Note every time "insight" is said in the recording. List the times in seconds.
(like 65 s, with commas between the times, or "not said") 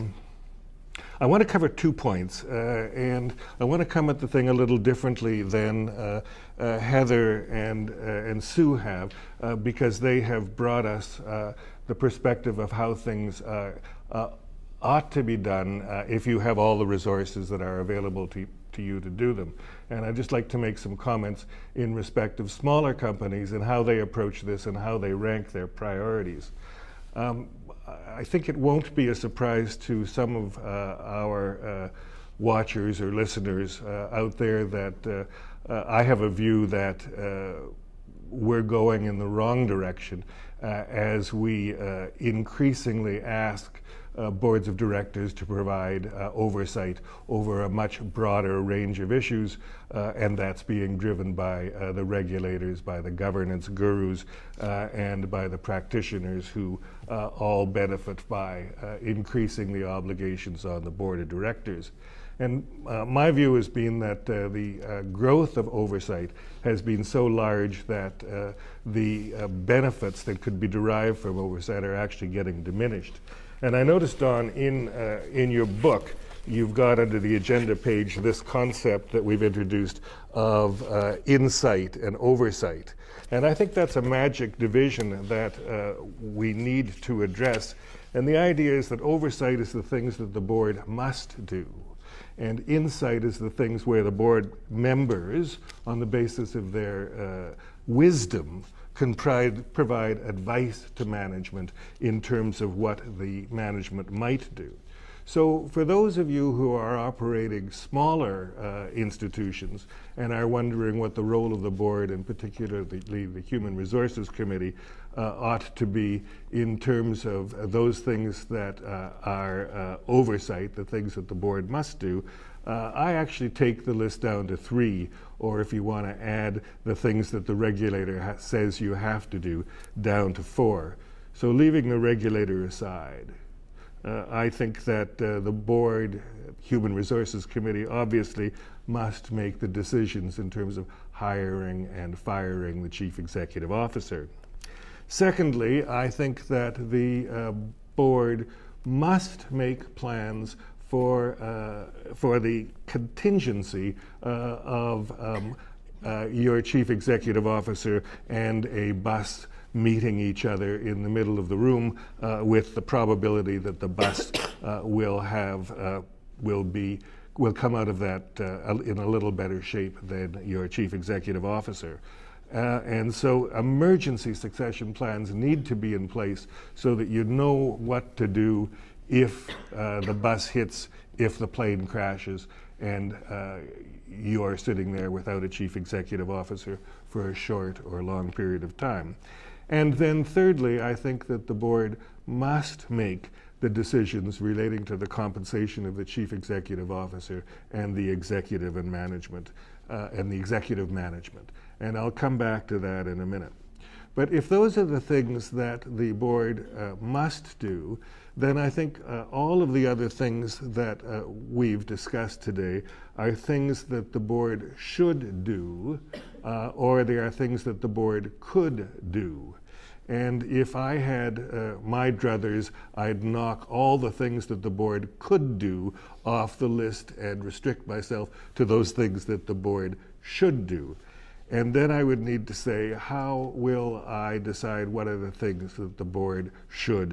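81 s, 92 s.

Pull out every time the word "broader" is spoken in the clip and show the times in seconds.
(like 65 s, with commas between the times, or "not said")
48 s.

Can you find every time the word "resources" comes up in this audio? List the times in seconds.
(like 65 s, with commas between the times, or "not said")
16 s, 113 s, 136 s.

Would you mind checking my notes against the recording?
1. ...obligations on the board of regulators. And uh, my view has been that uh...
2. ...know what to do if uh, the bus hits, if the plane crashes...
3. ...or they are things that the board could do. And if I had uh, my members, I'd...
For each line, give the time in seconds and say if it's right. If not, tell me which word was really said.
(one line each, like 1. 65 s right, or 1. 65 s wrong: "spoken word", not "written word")
1. 59 s wrong: "directors", not "regulators"
2. 177 s right
3. 216 s wrong: "druthers", not "members".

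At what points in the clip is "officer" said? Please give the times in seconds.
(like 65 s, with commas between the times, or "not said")
143 s, 157 s, 171 s, 186 s, 196 s.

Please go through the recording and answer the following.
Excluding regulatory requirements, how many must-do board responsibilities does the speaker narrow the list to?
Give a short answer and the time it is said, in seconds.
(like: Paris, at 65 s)
3, at 124 s.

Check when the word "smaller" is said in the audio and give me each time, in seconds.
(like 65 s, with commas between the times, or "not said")
22 s, 107 s.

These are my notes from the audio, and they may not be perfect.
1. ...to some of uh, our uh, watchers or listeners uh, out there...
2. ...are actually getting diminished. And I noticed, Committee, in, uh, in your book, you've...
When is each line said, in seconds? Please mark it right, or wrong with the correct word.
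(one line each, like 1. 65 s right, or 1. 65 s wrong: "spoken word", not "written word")
1. 29 s right
2. 71 s wrong: "Don", not "Committee".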